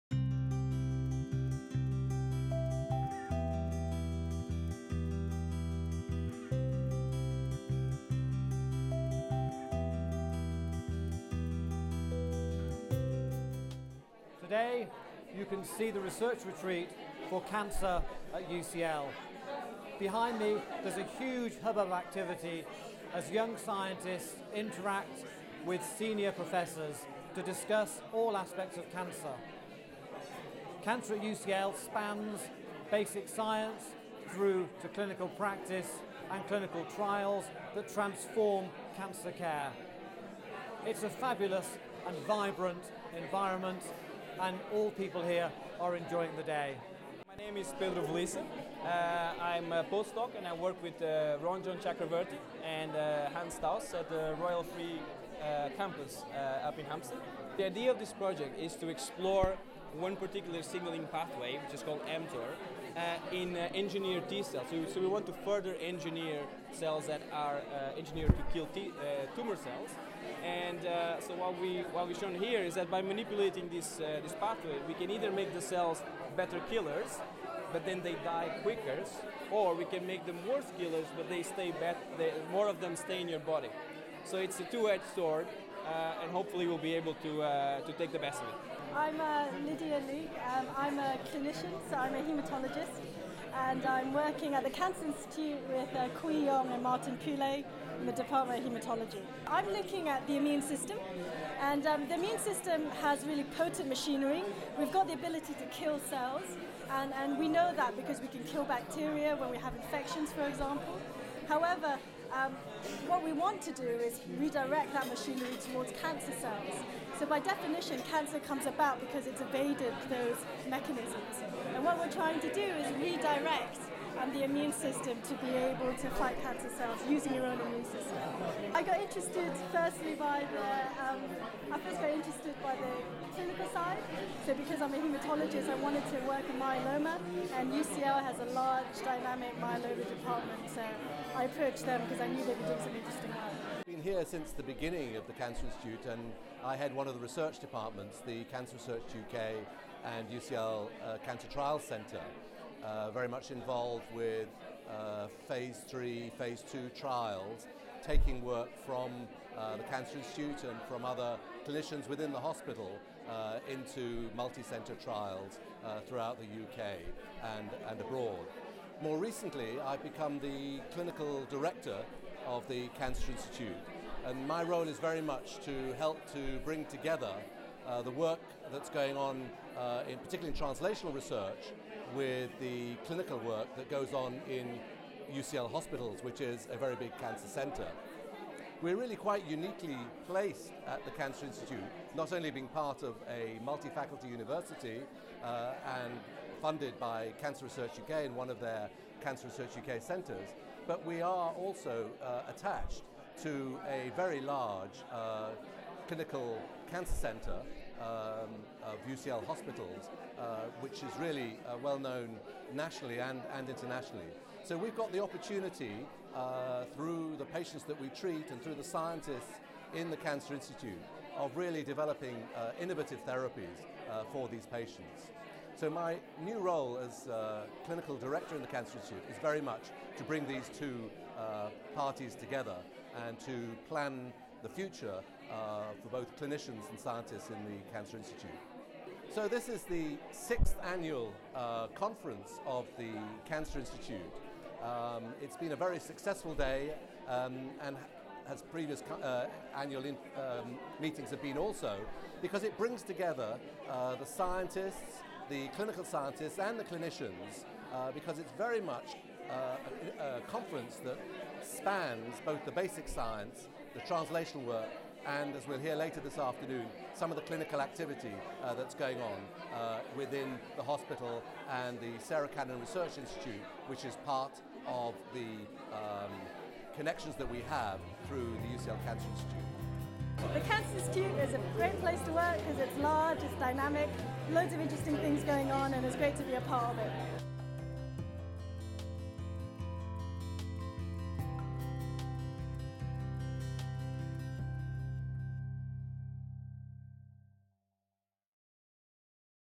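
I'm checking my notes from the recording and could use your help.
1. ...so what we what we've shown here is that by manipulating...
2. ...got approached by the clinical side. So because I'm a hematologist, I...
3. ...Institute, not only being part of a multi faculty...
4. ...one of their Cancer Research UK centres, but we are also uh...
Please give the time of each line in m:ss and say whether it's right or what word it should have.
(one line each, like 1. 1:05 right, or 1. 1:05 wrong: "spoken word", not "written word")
1. 1:11 right
2. 2:11 wrong: "interested", not "approached"
3. 3:11 right
4. 3:18 right.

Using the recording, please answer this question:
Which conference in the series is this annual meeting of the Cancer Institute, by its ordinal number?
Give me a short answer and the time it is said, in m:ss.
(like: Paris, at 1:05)
Sixth, at 4:00.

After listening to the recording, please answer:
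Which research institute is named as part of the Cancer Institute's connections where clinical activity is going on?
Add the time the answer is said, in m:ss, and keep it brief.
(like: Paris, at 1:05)
Sarah Cannon Research Institute, at 4:32.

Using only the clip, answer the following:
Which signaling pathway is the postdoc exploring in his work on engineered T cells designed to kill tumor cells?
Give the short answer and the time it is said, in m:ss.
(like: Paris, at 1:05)
mTOR, at 1:02.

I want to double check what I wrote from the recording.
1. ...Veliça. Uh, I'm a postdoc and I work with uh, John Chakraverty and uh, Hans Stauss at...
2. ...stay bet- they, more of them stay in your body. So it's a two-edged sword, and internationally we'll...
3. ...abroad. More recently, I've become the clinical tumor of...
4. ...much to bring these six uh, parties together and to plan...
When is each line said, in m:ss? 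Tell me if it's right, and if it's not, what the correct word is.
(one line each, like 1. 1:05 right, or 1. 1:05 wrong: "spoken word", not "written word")
1. 0:48 right
2. 1:21 wrong: "hopefully", not "internationally"
3. 2:48 wrong: "director", not "tumor"
4. 3:49 wrong: "two", not "six".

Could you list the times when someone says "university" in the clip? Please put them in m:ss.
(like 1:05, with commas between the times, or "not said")
3:14.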